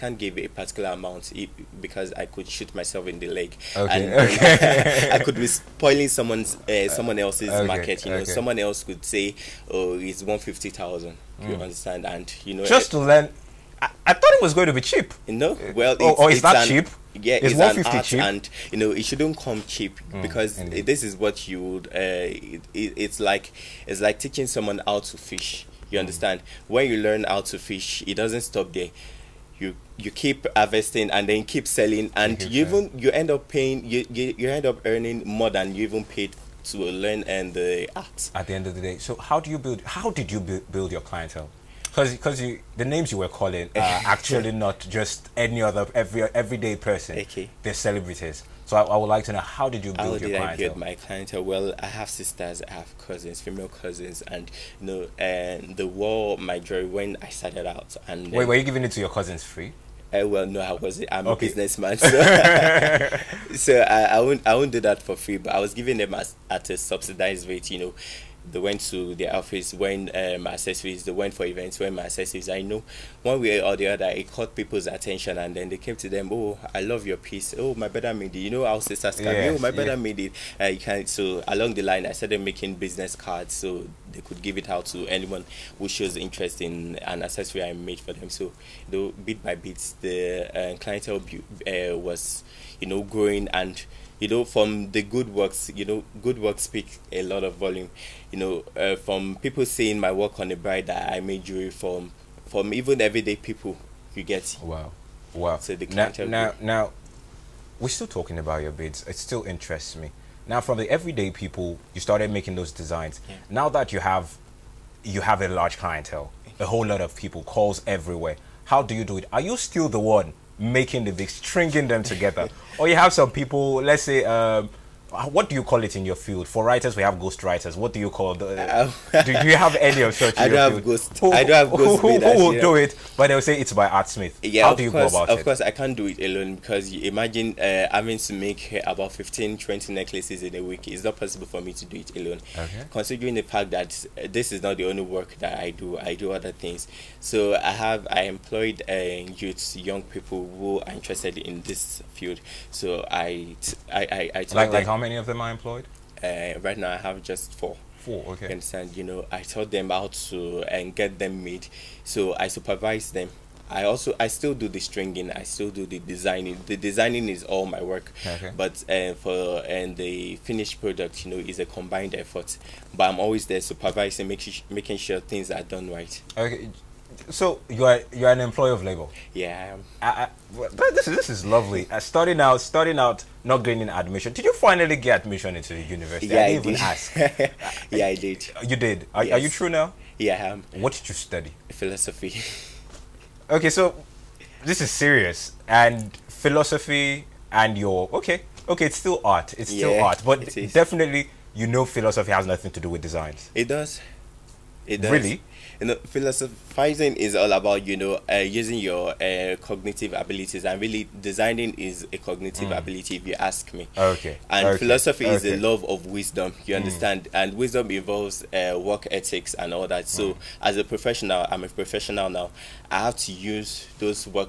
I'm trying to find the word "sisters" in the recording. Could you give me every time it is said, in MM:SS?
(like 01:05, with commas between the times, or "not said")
00:52, 01:18.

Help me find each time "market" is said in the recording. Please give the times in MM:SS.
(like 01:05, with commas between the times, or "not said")
00:07.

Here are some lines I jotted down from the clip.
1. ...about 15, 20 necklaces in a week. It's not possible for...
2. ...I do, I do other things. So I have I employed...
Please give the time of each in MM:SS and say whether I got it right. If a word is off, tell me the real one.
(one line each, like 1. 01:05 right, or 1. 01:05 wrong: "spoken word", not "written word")
1. 02:18 right
2. 02:25 right.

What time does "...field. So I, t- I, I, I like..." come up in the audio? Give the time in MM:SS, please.
02:32.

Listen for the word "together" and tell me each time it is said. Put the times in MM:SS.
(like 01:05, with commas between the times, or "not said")
02:02.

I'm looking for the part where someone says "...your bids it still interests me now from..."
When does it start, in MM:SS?
01:48.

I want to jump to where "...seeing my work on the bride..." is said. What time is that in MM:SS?
01:39.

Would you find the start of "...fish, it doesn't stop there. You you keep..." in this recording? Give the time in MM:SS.
00:27.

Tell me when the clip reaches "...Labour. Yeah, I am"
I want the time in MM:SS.
02:58.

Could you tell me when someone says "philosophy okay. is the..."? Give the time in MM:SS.
03:34.